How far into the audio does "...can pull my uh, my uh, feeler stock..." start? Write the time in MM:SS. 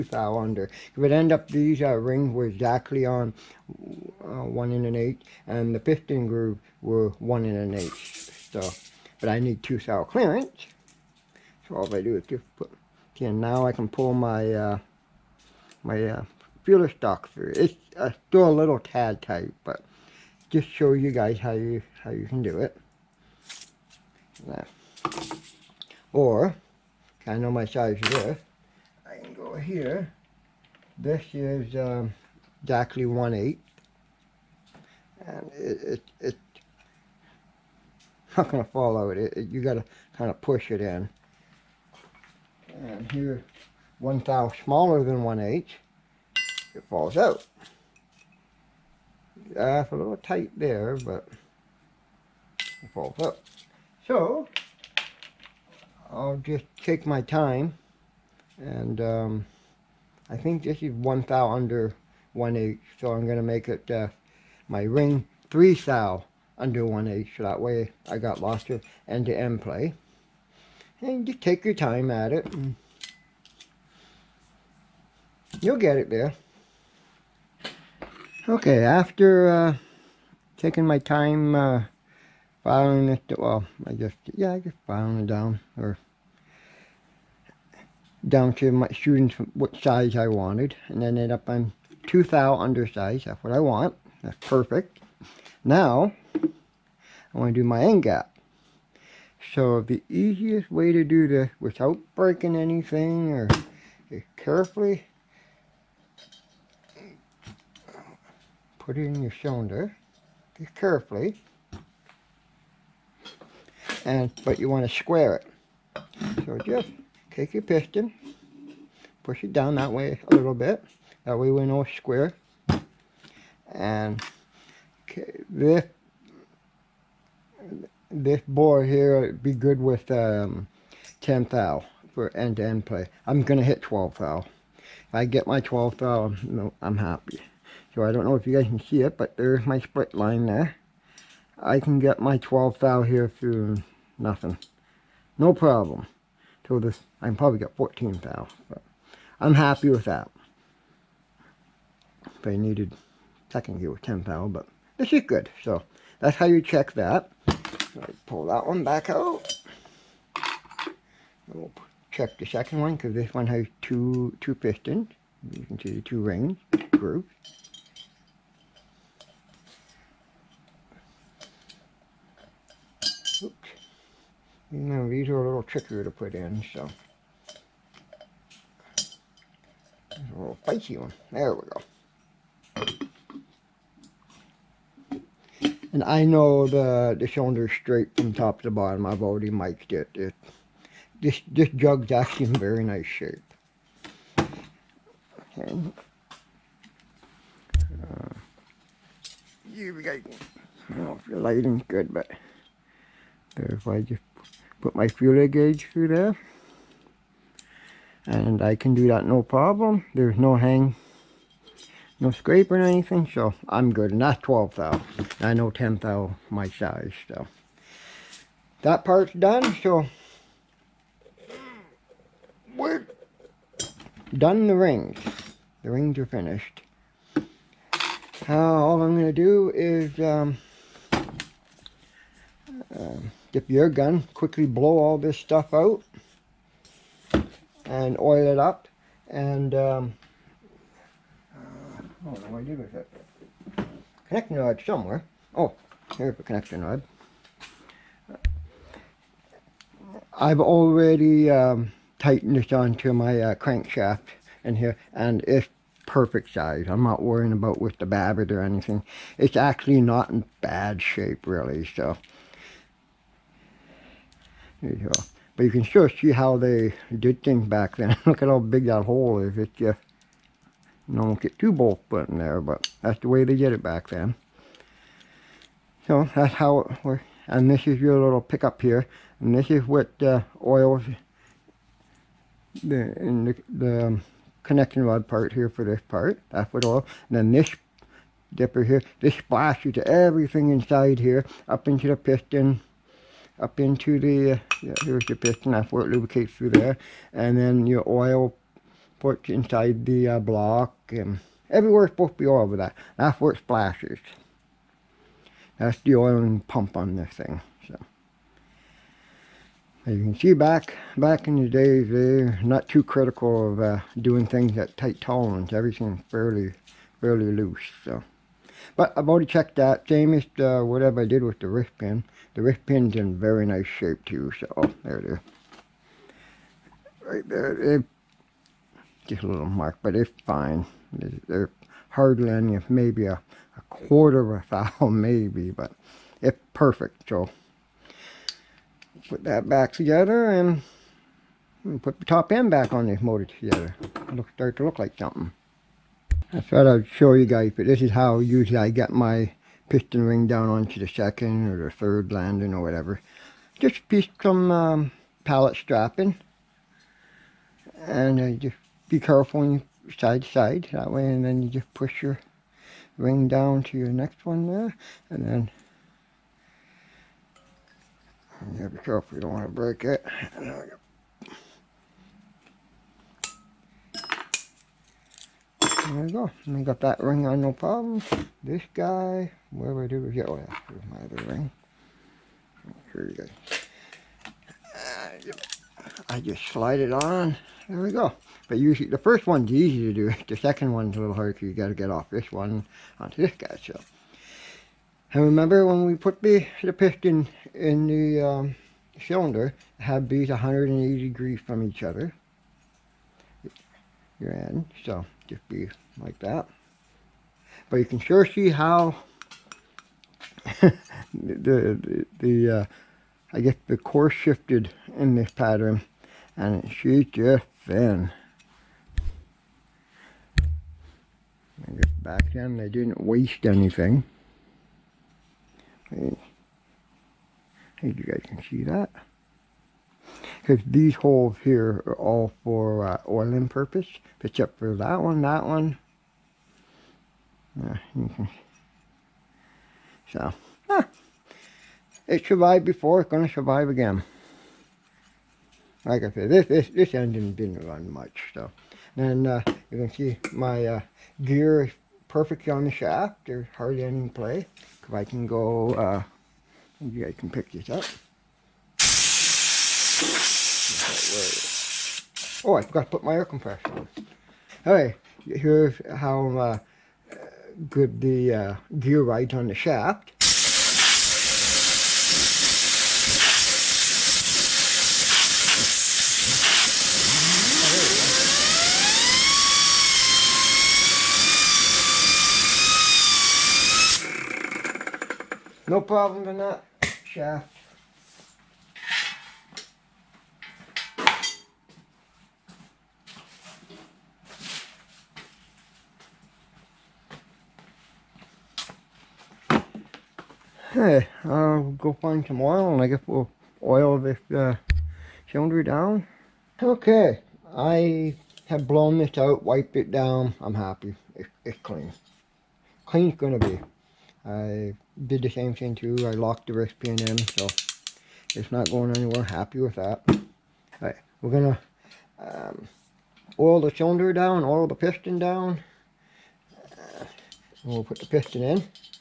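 00:13.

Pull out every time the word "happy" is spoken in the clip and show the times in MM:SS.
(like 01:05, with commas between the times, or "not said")
02:16, 02:29, 08:30, 08:39.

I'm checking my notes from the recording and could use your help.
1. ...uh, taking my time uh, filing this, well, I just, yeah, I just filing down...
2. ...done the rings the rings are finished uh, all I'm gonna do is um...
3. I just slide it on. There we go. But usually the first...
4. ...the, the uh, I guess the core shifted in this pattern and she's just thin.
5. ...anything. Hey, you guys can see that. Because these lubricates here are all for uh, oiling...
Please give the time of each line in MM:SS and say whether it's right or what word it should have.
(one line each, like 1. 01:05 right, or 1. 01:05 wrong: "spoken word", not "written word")
1. 01:19 right
2. 03:44 right
3. 06:26 right
4. 06:51 right
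5. 07:03 wrong: "holes", not "lubricates".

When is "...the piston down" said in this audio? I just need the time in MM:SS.
08:44.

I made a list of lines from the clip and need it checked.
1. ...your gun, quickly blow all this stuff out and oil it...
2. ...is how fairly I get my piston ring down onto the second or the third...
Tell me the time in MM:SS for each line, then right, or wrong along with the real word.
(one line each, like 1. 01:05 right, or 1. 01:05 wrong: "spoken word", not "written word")
1. 03:53 right
2. 05:48 wrong: "usually", not "fairly".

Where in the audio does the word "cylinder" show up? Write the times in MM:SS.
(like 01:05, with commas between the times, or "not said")
01:49, 03:07, 06:39, 08:25, 08:43.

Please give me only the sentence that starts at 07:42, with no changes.
Oh, I forgot to put my air compressor on.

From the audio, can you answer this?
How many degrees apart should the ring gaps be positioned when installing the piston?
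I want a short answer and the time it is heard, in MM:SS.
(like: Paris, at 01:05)
180, at 06:40.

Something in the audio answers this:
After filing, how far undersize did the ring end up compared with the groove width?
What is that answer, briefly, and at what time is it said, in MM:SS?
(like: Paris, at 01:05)
2 thou, at 01:32.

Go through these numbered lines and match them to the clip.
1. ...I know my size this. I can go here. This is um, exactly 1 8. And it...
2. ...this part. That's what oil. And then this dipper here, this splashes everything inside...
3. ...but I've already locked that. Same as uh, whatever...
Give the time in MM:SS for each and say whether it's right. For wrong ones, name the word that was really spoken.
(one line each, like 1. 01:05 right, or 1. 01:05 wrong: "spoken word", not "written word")
1. 00:27 right
2. 04:45 right
3. 05:18 wrong: "checked", not "locked".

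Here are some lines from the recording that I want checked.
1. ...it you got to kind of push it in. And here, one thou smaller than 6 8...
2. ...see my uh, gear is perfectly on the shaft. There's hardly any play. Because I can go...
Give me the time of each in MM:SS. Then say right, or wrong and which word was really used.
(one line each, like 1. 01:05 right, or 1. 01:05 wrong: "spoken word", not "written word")
1. 00:39 wrong: "1", not "6"
2. 07:30 right.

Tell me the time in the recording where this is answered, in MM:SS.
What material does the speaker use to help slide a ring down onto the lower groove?
05:55.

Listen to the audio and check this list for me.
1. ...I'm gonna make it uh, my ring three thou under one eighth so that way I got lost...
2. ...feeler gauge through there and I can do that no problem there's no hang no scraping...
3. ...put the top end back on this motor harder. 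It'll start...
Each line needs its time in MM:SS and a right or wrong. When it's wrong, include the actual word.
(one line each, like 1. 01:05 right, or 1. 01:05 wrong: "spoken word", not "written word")
1. 01:03 right
2. 03:25 right
3. 05:42 wrong: "together", not "harder".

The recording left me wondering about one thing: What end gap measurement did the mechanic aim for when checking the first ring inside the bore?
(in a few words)
12 thou.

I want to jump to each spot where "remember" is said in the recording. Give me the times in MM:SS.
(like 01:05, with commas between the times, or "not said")
06:35.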